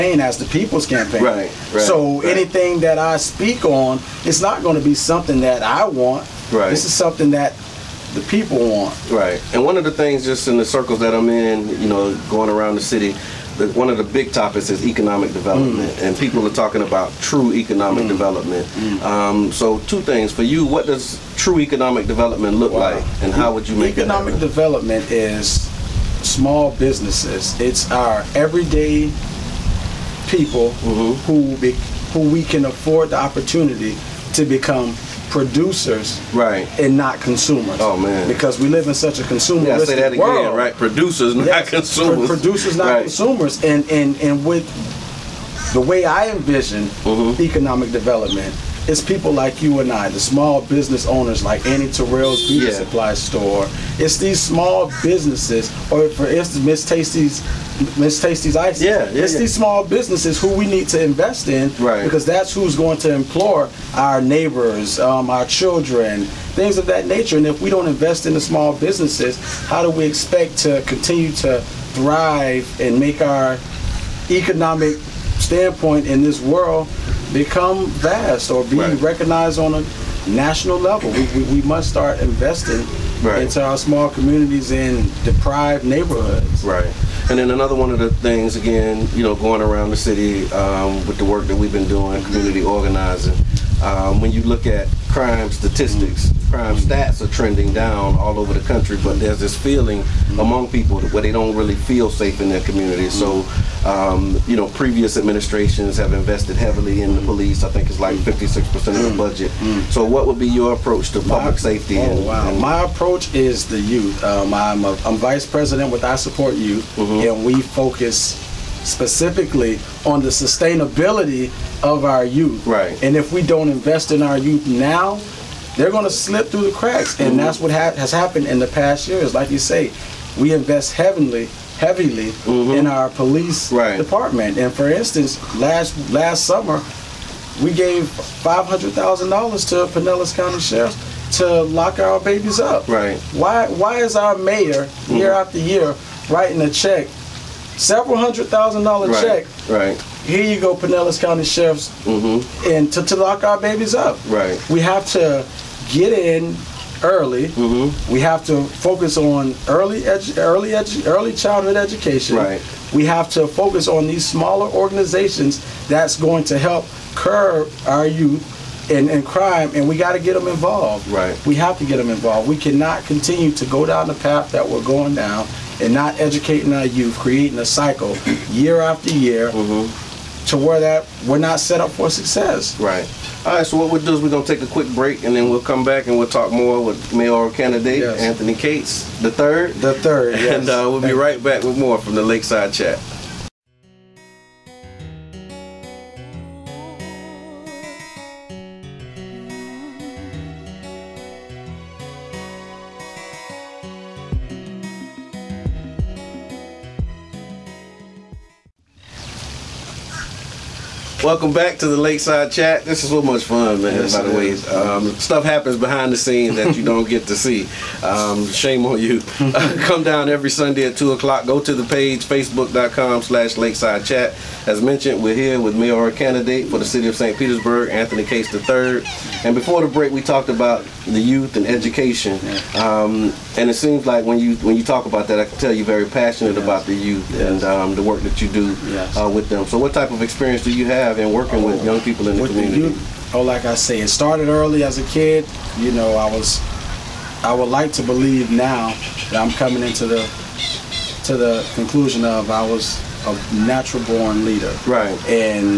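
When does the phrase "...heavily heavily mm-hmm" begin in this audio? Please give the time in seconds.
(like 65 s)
130 s.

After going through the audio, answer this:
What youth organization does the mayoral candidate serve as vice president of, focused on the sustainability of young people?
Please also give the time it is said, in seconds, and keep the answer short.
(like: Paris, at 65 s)
I Support Youth, at 116 s.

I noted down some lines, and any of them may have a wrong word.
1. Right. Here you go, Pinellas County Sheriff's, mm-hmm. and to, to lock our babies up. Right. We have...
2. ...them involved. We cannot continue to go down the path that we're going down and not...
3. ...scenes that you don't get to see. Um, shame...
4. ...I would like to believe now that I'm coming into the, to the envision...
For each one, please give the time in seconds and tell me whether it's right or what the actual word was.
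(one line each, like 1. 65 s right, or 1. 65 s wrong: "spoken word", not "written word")
1. 149 s right
2. 171 s right
3. 216 s right
4. 247 s wrong: "conclusion", not "envision".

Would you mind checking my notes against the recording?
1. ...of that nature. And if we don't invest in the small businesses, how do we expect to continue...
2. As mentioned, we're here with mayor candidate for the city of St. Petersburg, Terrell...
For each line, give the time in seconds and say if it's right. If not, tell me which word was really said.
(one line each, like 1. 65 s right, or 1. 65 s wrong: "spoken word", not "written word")
1. 66 s right
2. 224 s wrong: "Anthony", not "Terrell".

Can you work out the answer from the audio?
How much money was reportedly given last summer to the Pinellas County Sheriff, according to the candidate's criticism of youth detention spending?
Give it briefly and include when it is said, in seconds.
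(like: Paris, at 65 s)
$500,000, at 138 s.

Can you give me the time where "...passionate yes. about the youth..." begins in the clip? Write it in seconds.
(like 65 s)
236 s.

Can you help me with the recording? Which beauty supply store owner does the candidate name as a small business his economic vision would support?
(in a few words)
Annie Terrell.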